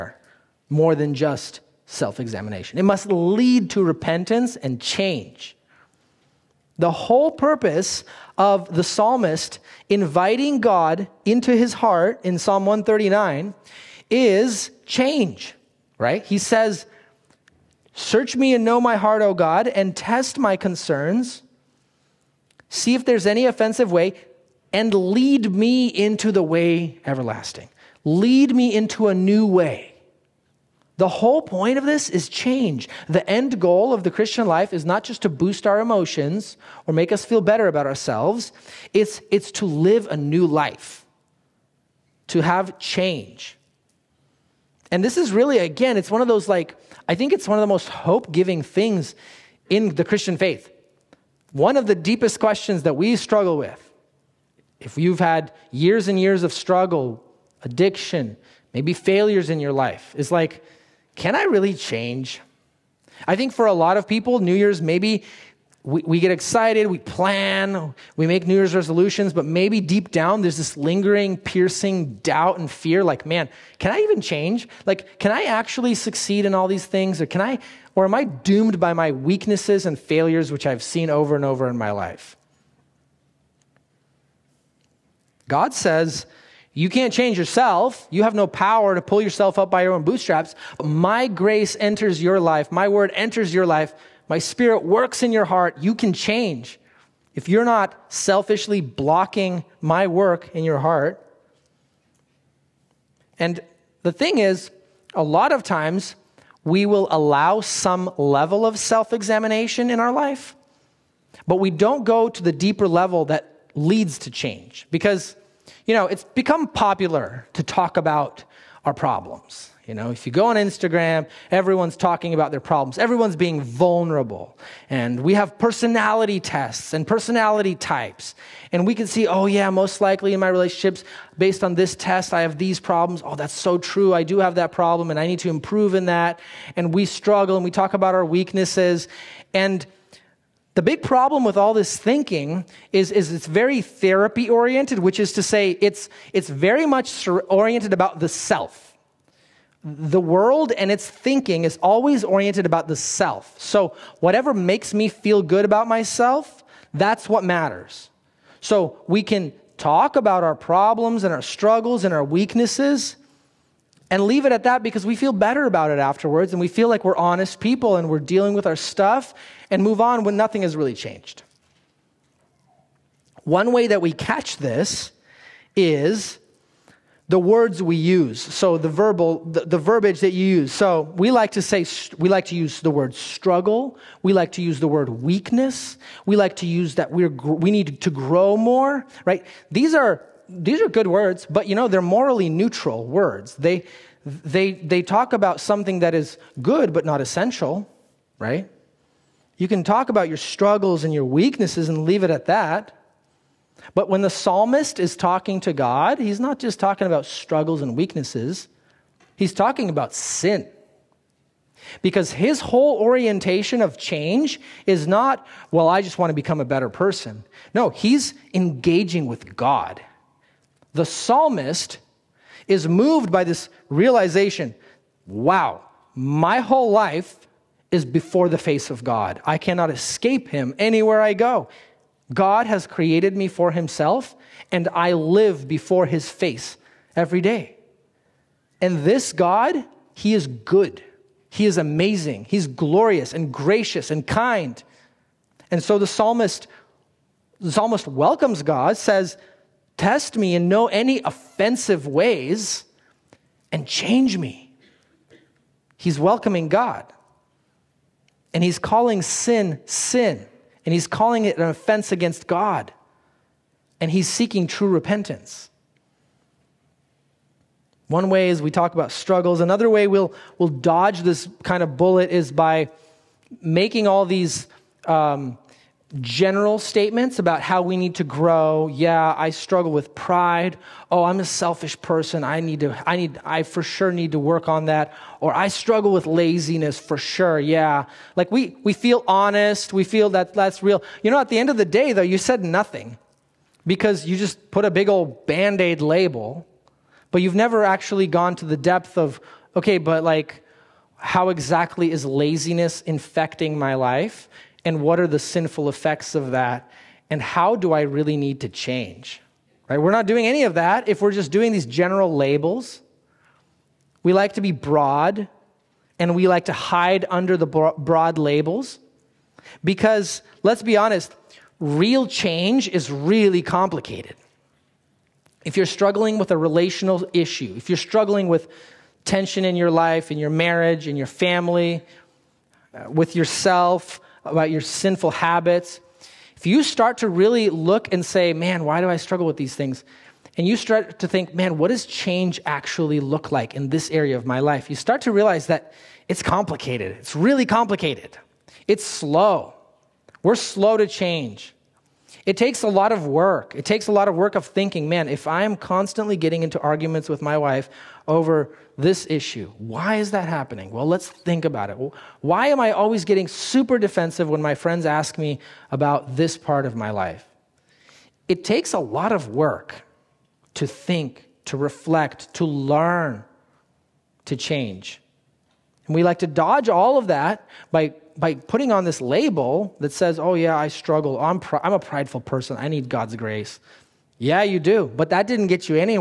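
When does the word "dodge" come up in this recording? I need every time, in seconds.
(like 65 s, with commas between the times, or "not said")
270 s, 376 s.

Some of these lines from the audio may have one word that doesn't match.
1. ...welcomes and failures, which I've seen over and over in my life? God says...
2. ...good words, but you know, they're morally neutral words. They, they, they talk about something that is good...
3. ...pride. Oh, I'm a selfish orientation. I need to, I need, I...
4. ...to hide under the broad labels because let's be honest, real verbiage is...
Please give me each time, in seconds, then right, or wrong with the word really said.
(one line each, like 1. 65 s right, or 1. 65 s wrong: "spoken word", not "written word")
1. 79 s wrong: "weaknesses", not "welcomes"
2. 190 s right
3. 280 s wrong: "person", not "orientation"
4. 316 s wrong: "change", not "verbiage".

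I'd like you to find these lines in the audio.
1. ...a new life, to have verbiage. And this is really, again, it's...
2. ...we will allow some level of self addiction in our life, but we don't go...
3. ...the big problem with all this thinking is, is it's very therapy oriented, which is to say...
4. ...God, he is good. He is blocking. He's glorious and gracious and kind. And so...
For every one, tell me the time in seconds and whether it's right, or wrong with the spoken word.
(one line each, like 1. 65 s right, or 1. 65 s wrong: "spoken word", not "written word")
1. 40 s wrong: "change", not "verbiage"
2. 106 s wrong: "examination", not "addiction"
3. 140 s right
4. 239 s wrong: "amazing", not "blocking".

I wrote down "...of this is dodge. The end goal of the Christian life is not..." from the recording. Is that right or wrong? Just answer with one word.
wrong.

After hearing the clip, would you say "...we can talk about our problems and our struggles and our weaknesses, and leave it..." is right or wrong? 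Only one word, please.
right.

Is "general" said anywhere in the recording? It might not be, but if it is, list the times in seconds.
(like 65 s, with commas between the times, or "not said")
276 s, 311 s.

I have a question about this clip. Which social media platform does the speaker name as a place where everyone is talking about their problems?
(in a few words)
Instagram.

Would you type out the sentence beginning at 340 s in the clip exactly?
And you start to think, man, what does change actually look like in this area of my life?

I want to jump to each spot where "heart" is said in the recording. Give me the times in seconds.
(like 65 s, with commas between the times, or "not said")
11 s, 18 s, 95 s, 100 s.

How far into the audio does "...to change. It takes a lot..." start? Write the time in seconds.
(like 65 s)
350 s.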